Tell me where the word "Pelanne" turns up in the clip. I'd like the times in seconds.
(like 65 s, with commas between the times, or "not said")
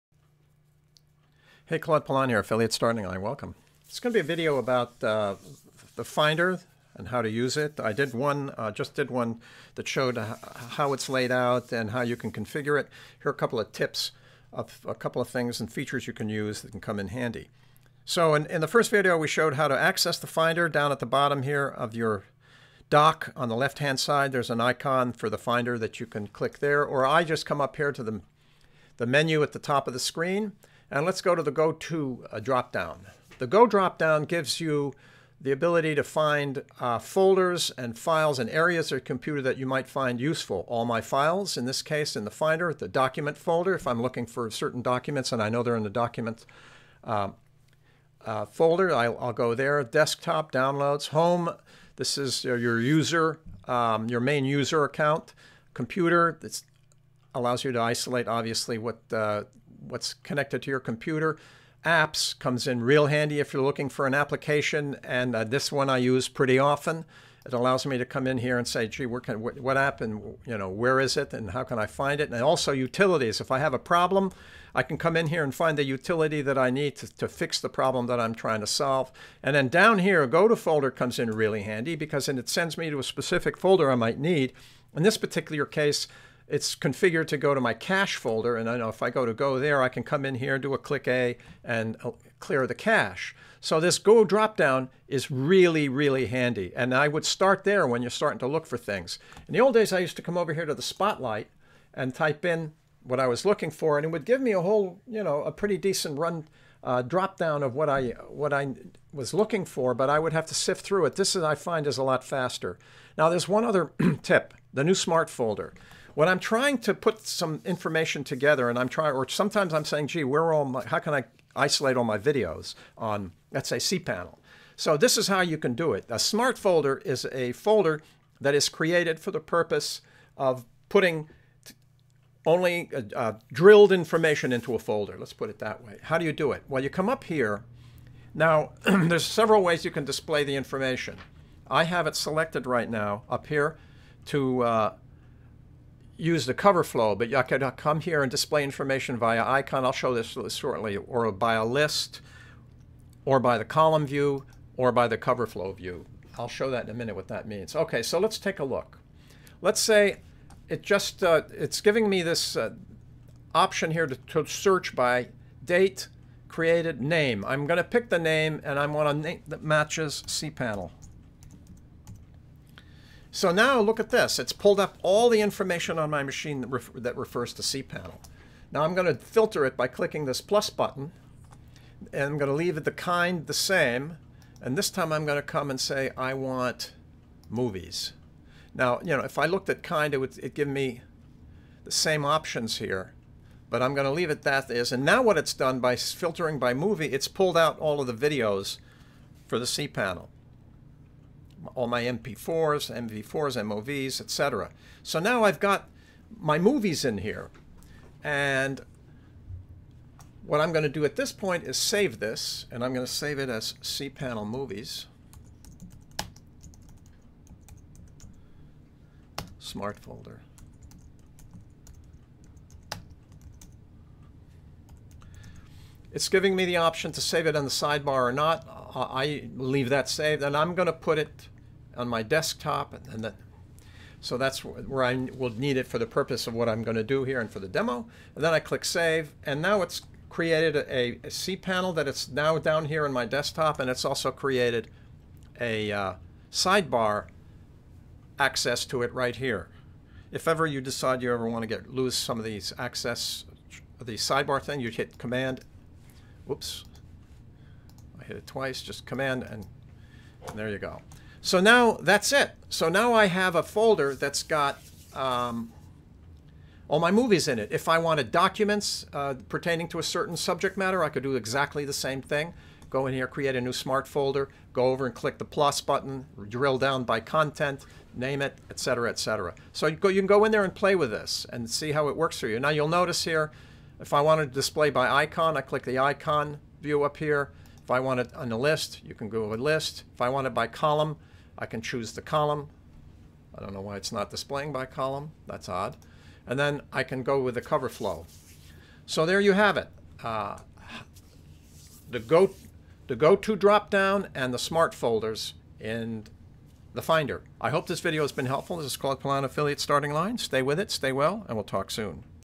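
2 s, 309 s.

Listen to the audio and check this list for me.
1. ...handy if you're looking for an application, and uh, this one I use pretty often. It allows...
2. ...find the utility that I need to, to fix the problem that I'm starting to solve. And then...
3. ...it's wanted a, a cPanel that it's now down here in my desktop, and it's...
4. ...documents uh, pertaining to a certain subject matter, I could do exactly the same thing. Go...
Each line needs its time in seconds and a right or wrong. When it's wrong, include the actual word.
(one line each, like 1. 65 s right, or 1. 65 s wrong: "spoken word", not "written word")
1. 63 s right
2. 75 s wrong: "trying", not "starting"
3. 239 s wrong: "created", not "wanted"
4. 268 s right.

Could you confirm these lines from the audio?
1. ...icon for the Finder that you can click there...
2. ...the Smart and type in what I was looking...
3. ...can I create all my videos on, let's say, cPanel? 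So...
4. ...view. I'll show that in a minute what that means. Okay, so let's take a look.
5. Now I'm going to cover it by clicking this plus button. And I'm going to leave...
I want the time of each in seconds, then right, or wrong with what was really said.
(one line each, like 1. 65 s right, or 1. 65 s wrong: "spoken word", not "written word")
1. 24 s right
2. 100 s wrong: "Spotlight", not "Smart"
3. 120 s wrong: "isolate", not "create"
4. 155 s right
5. 178 s wrong: "filter", not "cover".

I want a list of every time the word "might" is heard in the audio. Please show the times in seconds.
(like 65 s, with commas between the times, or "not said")
39 s, 83 s.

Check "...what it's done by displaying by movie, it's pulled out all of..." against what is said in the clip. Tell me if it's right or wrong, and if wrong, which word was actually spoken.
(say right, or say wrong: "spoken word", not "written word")
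wrong: "filtering", not "displaying".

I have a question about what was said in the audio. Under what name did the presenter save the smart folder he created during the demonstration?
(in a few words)
cPanel Movies.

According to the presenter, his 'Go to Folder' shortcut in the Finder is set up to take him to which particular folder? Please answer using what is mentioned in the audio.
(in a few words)
cache folder.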